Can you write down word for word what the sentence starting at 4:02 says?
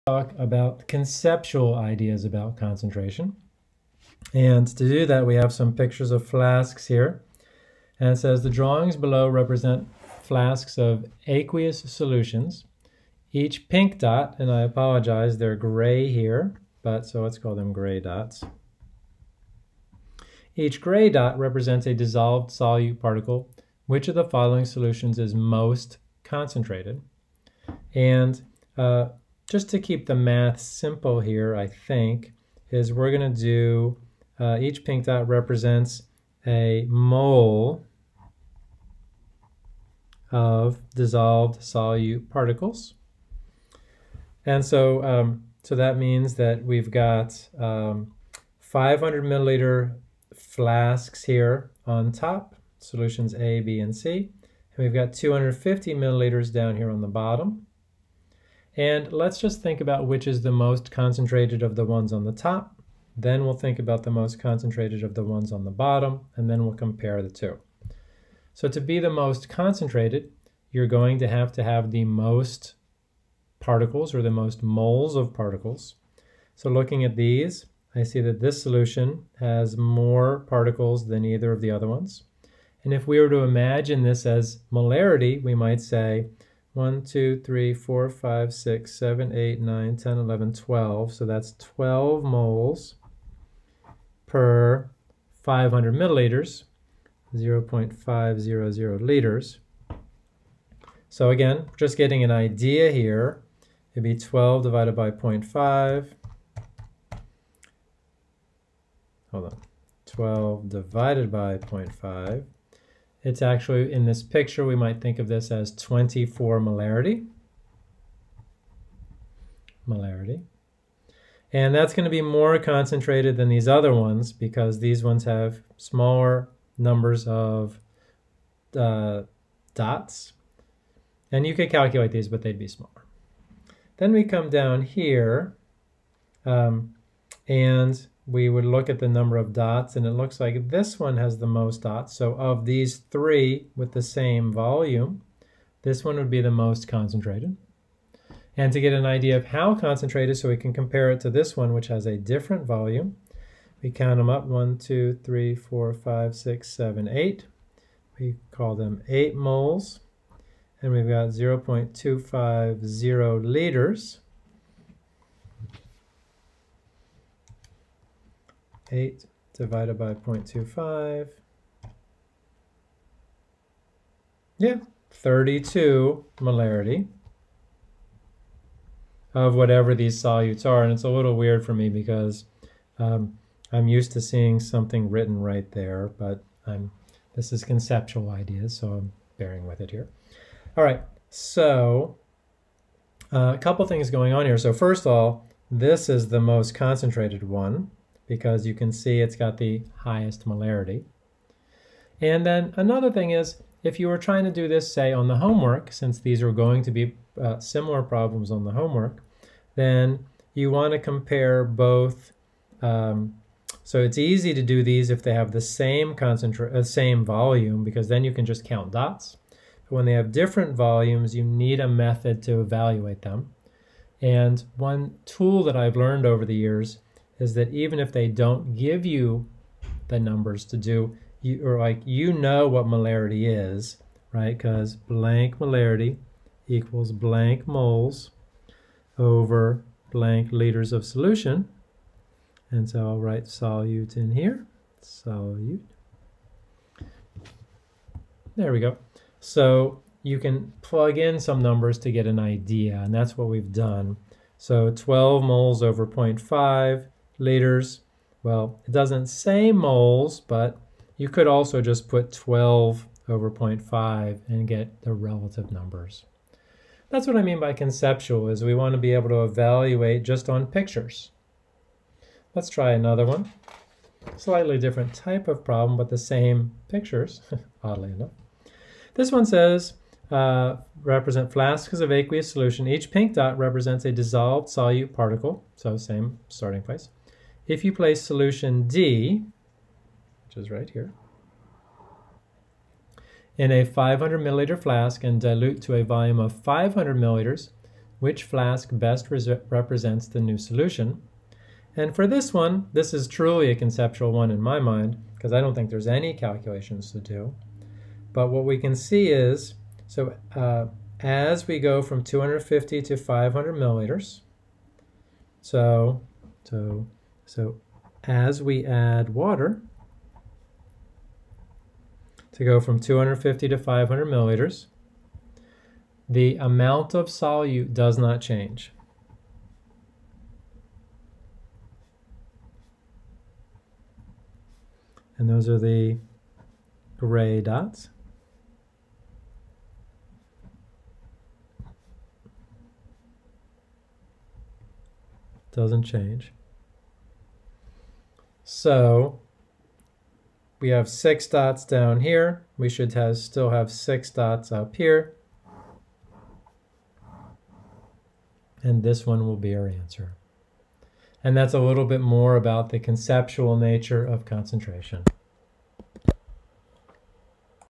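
And so I'll write solute in here, solute.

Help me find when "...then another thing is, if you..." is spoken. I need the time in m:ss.
3:22.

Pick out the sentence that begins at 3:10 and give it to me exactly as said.
All right, so uh, a couple things going on here.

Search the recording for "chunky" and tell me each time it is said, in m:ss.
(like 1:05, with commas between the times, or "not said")
not said.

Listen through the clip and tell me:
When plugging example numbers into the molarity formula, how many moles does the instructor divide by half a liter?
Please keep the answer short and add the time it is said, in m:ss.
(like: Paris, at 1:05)
12, at 4:14.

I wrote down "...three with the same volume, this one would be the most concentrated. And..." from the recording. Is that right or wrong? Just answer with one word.
right.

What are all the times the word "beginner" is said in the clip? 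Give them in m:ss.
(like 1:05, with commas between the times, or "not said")
not said.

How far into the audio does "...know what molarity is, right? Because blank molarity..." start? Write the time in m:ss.
3:52.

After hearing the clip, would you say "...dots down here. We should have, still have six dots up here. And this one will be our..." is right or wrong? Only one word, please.
right.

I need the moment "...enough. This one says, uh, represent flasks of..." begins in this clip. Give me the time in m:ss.
4:38.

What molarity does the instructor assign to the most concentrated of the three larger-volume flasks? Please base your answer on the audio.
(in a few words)
24 molarity.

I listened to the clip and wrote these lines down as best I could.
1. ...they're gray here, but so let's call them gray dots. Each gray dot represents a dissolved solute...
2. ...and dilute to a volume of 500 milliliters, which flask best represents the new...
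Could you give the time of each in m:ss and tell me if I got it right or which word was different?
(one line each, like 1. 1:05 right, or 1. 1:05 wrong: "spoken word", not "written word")
1. 0:15 right
2. 4:55 right.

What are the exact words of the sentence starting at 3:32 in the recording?
Um, so it's easy to do these if they have the same uh, same volume, because then you can just count dots.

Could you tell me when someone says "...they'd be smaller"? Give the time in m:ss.
2:12.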